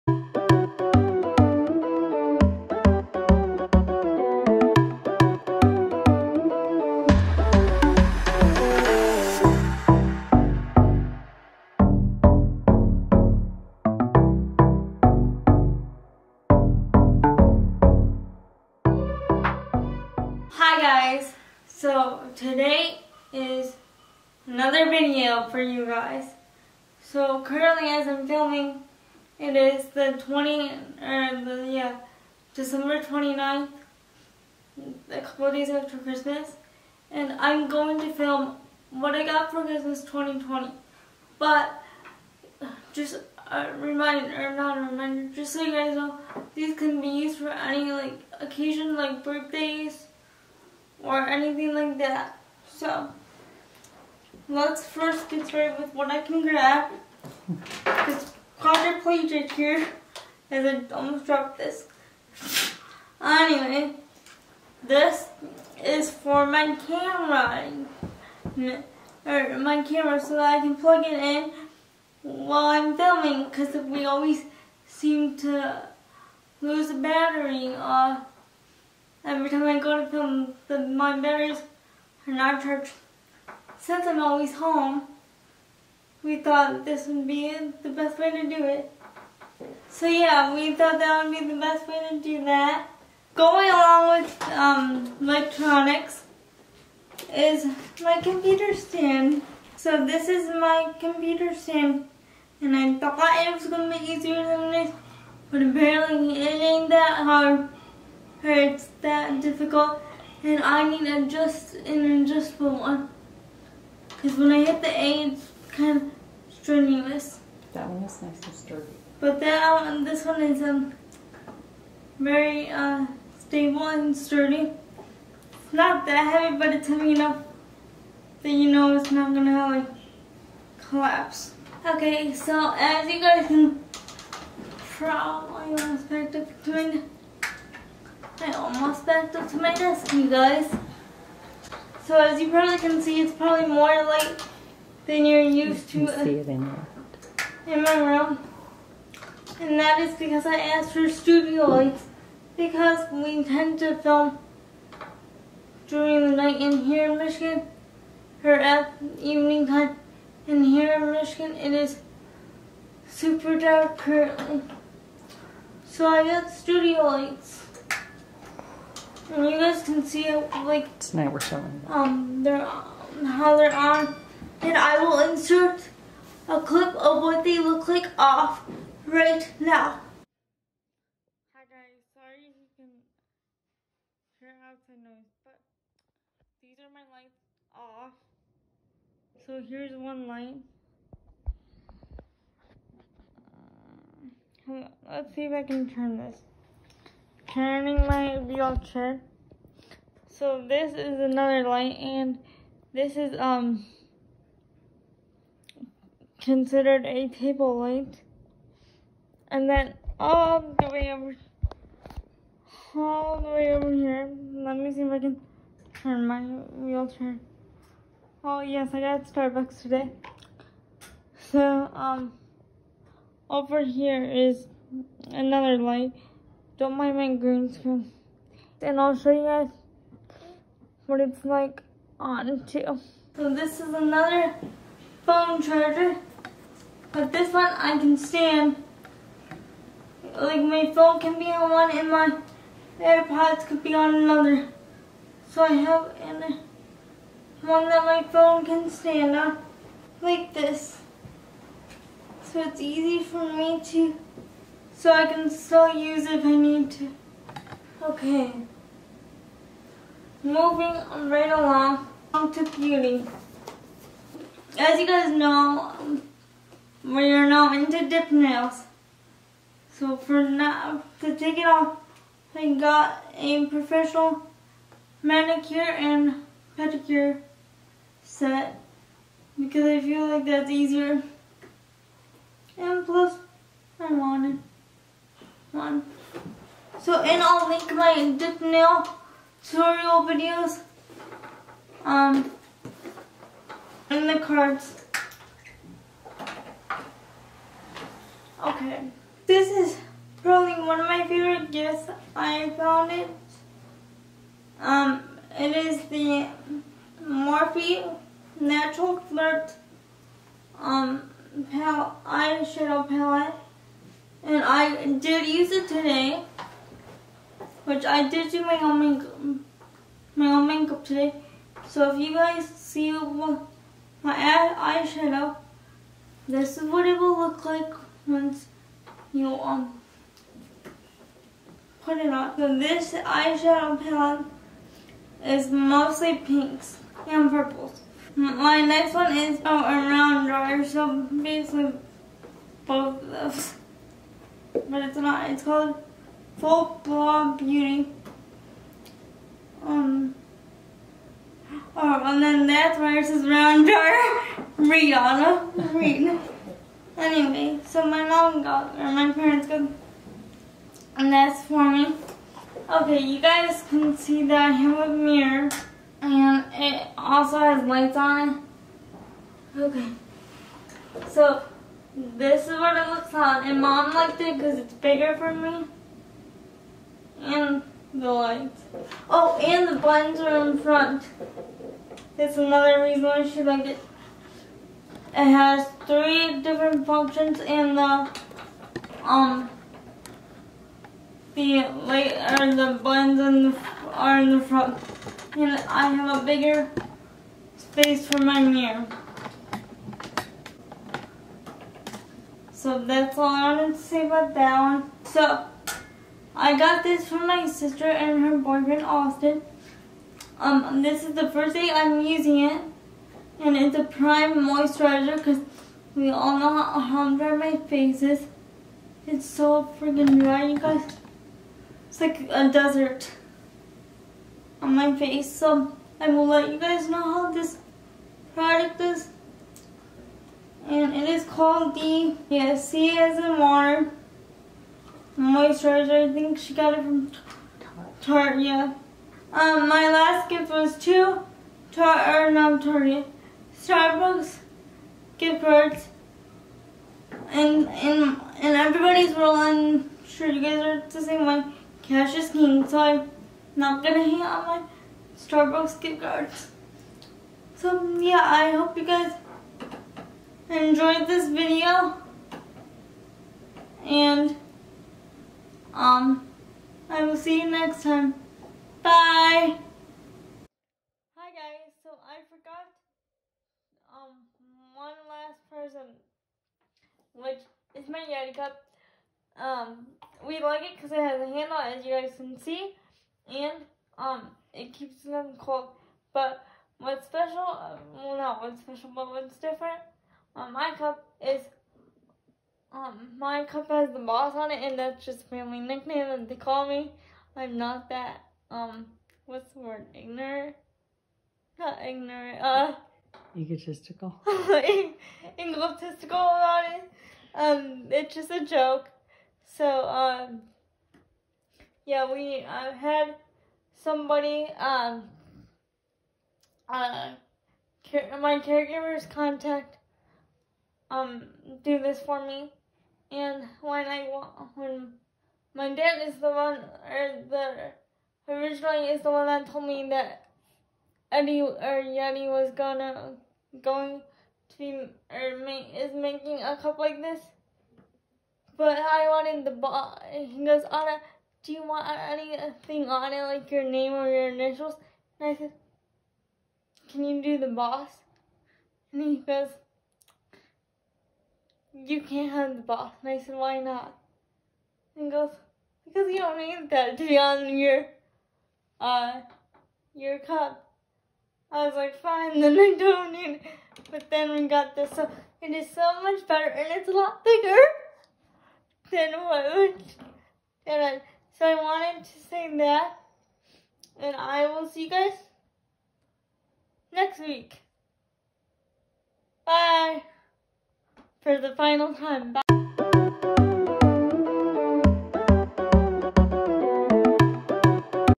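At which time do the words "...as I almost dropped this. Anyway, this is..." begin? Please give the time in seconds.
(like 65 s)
60 s.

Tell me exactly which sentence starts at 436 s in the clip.
I think she got it from Tarte, yeah.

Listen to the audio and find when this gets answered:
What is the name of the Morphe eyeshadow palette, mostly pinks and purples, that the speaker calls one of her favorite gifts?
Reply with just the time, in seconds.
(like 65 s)
308 s.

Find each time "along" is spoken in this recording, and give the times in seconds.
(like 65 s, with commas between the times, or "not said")
93 s, 261 s.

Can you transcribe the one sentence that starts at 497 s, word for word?
I'm not that, um, what's the word, ignorant?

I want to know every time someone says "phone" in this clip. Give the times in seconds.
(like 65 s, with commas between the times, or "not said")
235 s, 240 s, 248 s.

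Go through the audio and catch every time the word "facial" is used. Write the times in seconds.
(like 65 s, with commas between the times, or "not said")
not said.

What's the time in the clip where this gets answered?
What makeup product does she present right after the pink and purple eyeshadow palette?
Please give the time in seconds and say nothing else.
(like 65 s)
346 s.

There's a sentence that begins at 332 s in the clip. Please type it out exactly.
So this eyeshadow palette is mostly pinks and purples.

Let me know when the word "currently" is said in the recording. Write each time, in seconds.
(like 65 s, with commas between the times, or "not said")
27 s, 163 s.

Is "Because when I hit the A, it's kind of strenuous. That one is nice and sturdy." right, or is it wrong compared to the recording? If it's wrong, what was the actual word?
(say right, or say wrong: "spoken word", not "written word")
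right.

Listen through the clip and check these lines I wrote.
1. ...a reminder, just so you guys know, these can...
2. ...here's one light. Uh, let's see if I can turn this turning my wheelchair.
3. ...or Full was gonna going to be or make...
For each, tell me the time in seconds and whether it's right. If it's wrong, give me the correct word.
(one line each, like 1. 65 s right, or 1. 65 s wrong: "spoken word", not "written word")
1. 44 s right
2. 189 s right
3. 531 s wrong: "Yeti", not "Full".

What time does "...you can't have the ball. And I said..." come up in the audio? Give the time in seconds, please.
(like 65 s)
551 s.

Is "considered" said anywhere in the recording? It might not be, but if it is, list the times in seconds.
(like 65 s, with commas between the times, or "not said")
206 s.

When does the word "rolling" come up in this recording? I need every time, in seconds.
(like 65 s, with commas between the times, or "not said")
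449 s.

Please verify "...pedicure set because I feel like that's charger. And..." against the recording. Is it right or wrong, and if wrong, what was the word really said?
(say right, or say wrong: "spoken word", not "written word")
wrong: "easier", not "charger".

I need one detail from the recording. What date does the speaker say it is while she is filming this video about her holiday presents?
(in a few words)
December 29th.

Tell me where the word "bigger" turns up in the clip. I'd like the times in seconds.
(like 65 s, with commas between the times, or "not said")
374 s, 396 s, 567 s.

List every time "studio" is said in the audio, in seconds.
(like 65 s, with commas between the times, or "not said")
151 s, 166 s.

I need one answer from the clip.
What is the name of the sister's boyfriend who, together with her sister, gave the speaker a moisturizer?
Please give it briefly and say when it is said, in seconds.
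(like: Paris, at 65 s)
Austin, at 409 s.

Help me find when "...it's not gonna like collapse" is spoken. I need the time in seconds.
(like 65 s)
128 s.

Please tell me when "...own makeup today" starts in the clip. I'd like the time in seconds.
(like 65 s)
320 s.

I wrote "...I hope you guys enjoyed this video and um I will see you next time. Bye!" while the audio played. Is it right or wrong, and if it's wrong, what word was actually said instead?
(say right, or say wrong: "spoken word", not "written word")
right.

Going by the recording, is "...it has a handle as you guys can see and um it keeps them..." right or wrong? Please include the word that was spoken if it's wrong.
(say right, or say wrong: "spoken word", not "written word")
right.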